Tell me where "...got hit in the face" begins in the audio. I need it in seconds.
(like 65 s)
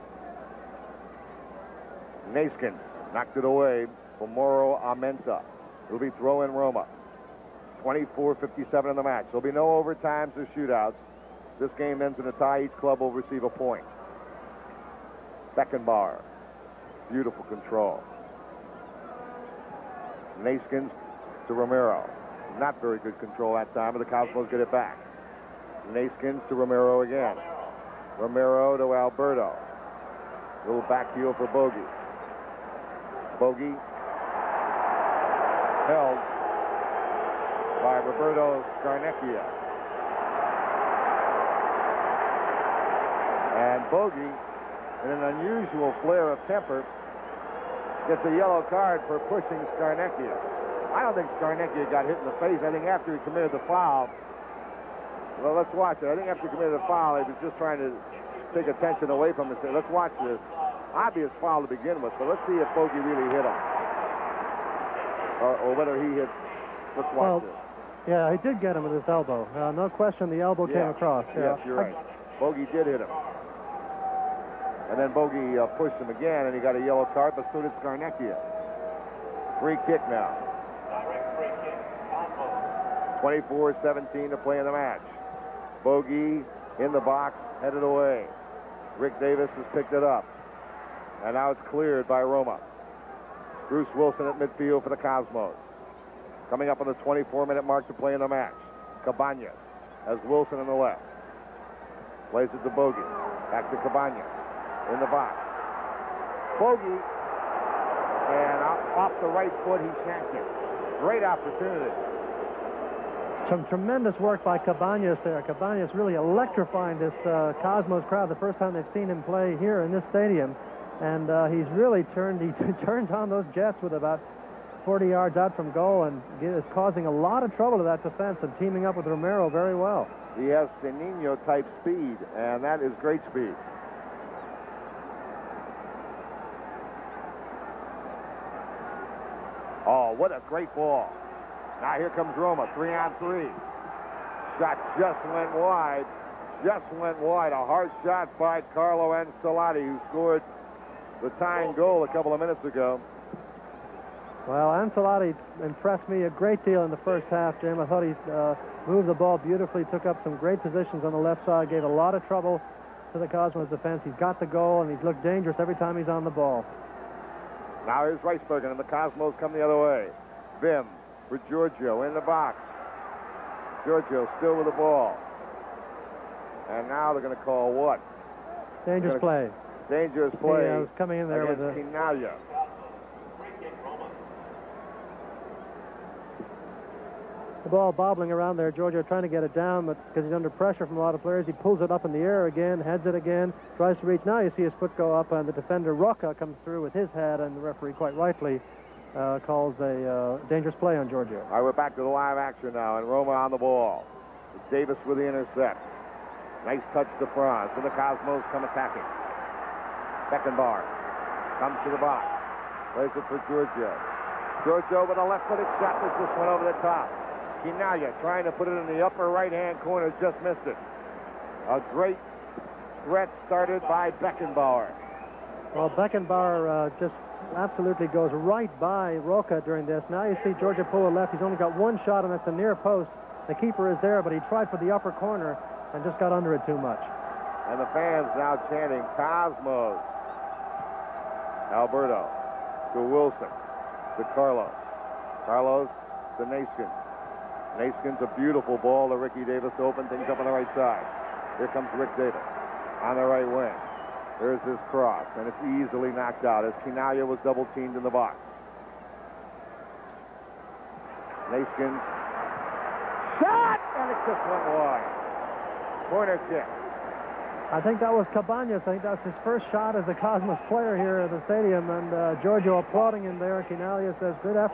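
51 s.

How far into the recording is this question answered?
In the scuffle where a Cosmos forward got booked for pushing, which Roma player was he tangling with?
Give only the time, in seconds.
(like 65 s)
38 s.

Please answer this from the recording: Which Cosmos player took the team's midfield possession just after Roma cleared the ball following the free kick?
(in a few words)
Bruce Wilson.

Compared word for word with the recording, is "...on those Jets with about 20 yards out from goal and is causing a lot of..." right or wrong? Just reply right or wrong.
wrong.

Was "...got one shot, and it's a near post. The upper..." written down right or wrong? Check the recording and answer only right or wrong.
wrong.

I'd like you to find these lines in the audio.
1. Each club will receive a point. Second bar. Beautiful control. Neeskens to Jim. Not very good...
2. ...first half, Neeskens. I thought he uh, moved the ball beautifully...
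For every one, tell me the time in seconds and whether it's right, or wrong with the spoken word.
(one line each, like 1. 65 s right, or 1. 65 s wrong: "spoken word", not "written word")
1. 12 s wrong: "Romero", not "Jim"
2. 157 s wrong: "Jim", not "Neeskens".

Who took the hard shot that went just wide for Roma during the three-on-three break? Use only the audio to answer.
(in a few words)
Carlo Ancelotti.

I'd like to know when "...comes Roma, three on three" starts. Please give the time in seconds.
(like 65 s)
142 s.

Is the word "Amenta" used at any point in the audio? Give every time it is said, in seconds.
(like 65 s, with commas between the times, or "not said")
4 s.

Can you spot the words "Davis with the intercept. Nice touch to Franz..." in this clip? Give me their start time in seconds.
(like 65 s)
204 s.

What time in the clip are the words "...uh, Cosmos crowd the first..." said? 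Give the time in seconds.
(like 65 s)
117 s.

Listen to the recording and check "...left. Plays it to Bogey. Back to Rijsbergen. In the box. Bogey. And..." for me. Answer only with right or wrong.
wrong.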